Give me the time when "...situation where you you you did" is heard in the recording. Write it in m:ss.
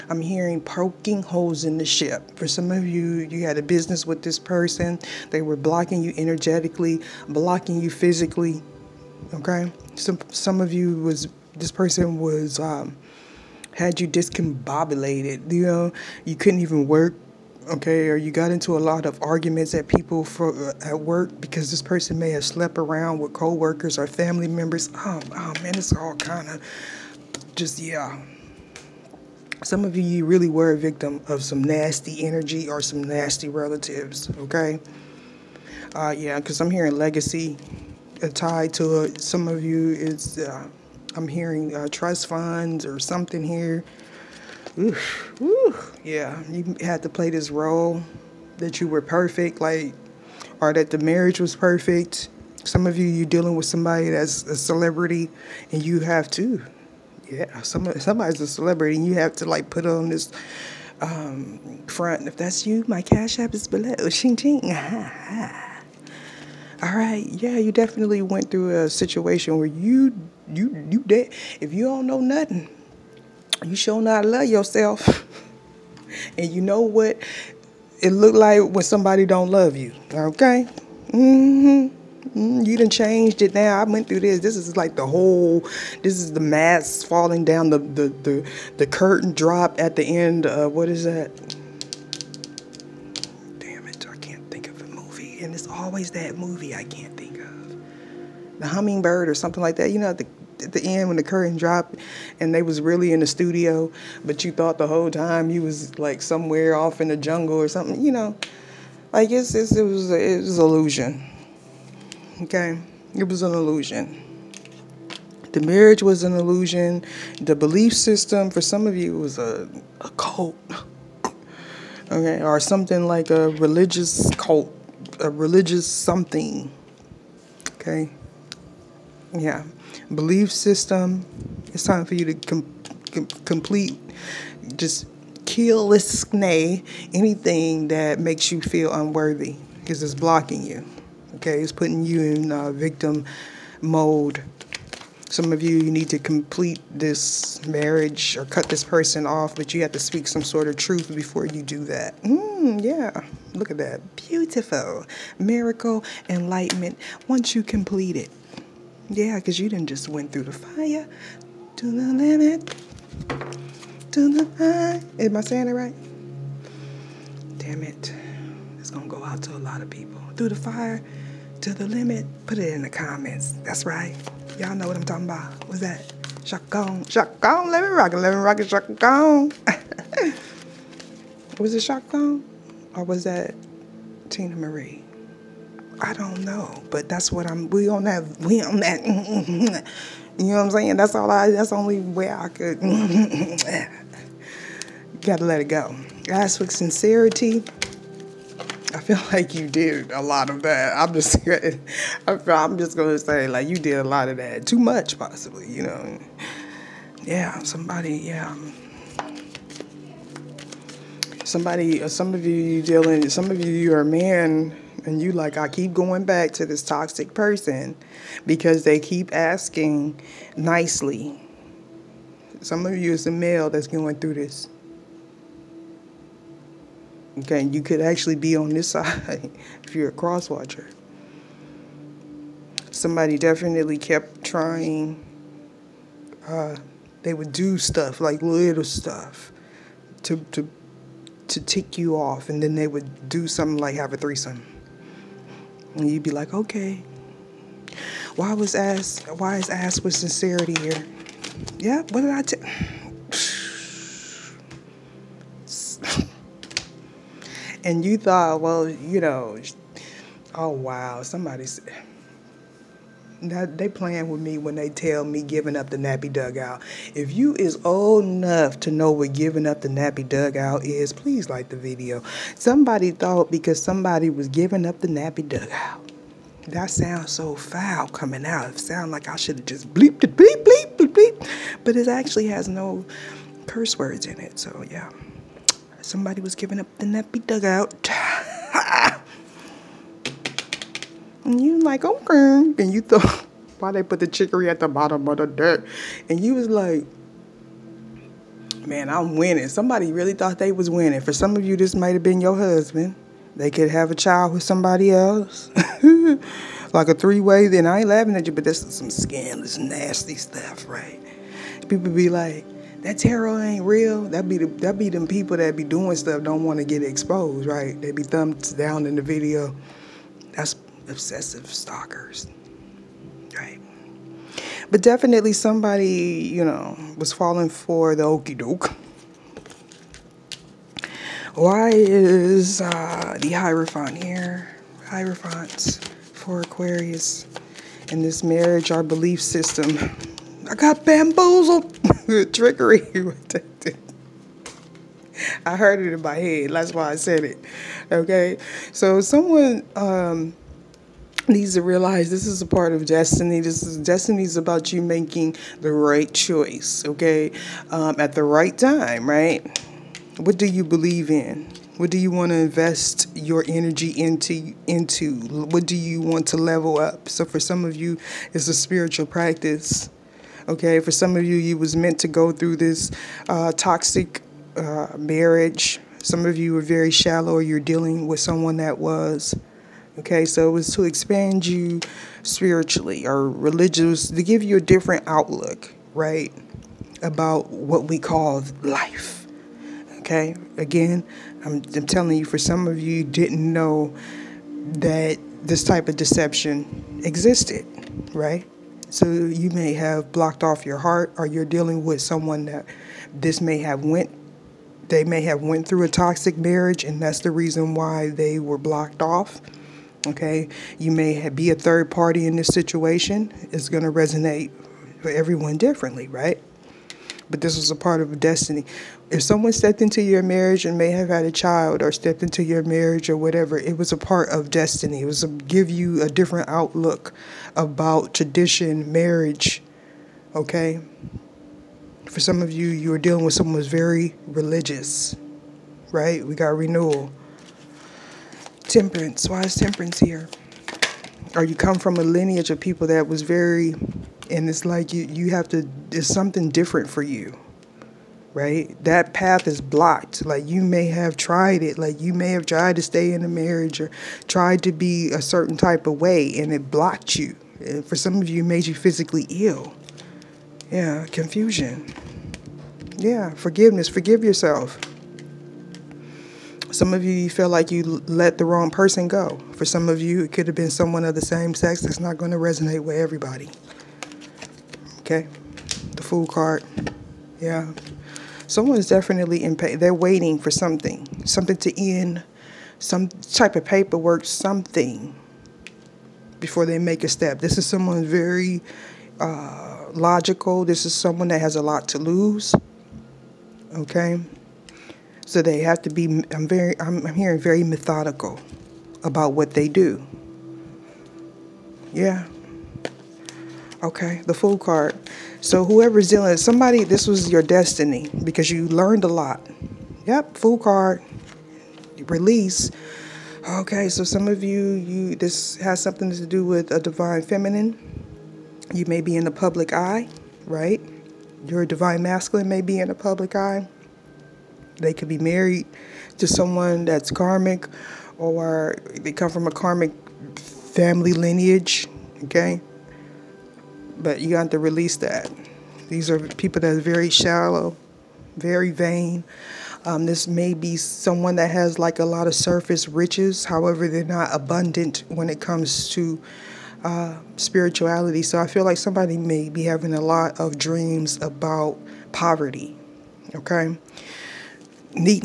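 1:08.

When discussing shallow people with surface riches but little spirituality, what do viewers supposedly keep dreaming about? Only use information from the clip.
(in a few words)
Poverty.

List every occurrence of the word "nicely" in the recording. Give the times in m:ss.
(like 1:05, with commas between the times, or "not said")
3:40.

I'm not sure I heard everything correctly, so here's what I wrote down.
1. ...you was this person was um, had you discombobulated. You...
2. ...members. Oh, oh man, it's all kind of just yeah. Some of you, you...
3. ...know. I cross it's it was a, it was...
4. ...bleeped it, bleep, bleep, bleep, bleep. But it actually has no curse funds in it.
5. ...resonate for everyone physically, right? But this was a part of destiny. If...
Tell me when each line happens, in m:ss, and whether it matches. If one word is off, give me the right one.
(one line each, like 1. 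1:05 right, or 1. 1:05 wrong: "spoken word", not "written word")
1. 0:10 right
2. 0:24 right
3. 1:48 wrong: "guess", not "cross"
4. 4:39 wrong: "words", not "funds"
5. 6:54 wrong: "differently", not "physically".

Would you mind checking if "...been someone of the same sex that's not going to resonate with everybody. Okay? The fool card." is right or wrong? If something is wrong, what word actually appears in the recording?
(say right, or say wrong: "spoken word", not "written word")
right.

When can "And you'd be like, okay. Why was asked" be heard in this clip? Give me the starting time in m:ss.
4:05.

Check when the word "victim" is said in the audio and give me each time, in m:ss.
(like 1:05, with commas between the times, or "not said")
0:30, 2:22.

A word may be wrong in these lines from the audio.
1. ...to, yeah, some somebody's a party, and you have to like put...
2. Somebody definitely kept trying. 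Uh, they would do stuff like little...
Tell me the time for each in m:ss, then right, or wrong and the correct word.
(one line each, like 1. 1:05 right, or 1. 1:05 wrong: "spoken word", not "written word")
1. 0:56 wrong: "celebrity", not "party"
2. 3:52 right.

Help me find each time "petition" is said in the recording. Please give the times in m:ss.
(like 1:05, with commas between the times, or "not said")
not said.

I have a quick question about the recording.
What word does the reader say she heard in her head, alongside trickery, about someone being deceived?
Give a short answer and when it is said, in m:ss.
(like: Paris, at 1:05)
Bamboozled, at 5:41.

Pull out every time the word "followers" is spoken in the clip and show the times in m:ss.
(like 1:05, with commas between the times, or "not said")
not said.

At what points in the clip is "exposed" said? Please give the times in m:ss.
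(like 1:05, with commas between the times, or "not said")
5:17.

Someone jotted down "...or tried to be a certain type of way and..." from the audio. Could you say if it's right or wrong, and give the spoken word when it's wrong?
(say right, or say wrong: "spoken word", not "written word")
right.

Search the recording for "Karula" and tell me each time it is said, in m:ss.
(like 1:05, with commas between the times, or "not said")
not said.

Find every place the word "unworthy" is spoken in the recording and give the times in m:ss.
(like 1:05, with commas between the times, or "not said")
2:18.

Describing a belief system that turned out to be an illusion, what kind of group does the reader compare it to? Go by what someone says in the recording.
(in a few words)
A religious cult.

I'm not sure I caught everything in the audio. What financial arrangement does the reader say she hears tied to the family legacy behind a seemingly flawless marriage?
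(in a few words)
Trust funds.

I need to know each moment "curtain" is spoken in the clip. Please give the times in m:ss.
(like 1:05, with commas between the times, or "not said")
1:28, 1:41.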